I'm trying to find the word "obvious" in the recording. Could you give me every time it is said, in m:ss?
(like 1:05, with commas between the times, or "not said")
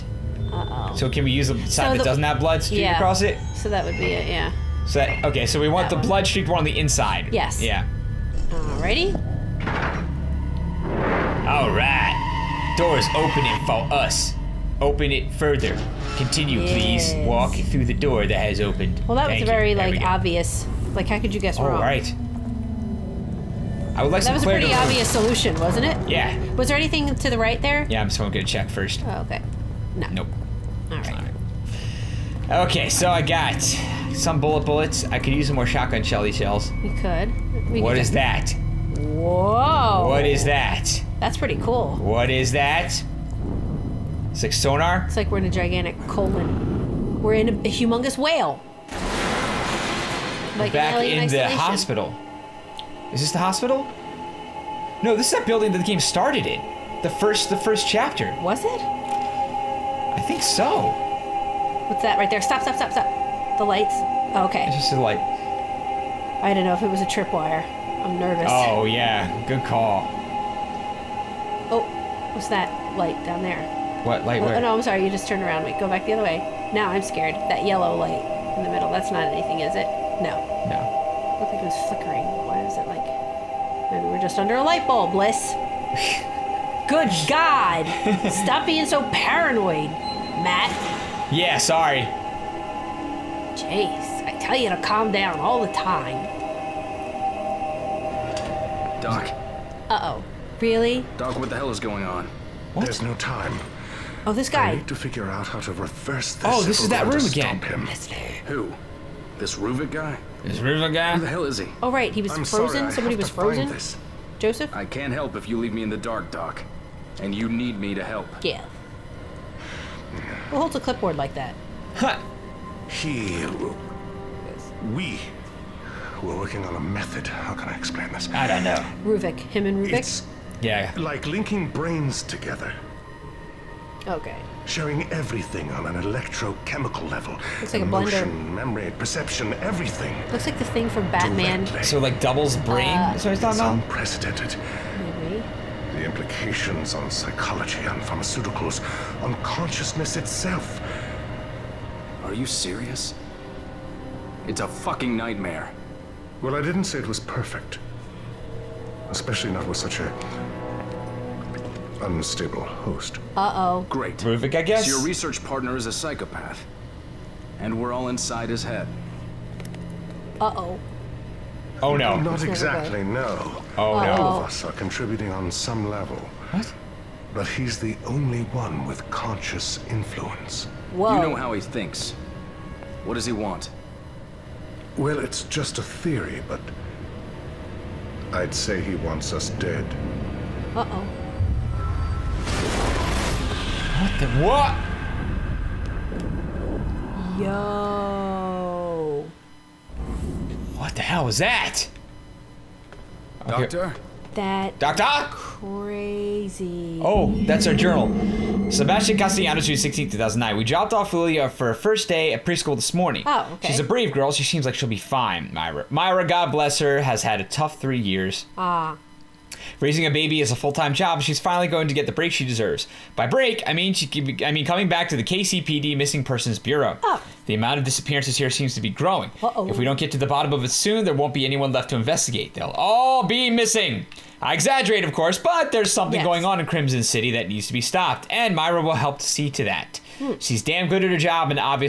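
0:20, 0:24.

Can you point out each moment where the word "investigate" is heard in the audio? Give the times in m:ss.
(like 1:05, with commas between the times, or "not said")
3:51.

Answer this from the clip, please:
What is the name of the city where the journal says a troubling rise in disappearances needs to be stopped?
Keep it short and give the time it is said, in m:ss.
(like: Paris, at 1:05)
Krimson City, at 3:56.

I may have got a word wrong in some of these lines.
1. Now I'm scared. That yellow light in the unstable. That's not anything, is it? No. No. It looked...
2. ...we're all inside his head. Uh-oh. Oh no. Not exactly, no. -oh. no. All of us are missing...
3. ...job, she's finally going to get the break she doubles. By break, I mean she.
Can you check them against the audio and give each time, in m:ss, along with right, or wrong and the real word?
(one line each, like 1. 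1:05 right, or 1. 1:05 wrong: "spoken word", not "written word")
1. 1:16 wrong: "middle", not "unstable"
2. 2:47 wrong: "contributing", not "missing"
3. 3:40 wrong: "deserves", not "doubles".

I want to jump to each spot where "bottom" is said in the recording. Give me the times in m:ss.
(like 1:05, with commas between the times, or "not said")
3:50.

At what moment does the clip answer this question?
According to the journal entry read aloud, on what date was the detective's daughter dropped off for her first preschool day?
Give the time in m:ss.
3:29.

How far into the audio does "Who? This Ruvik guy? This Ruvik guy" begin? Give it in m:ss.
1:48.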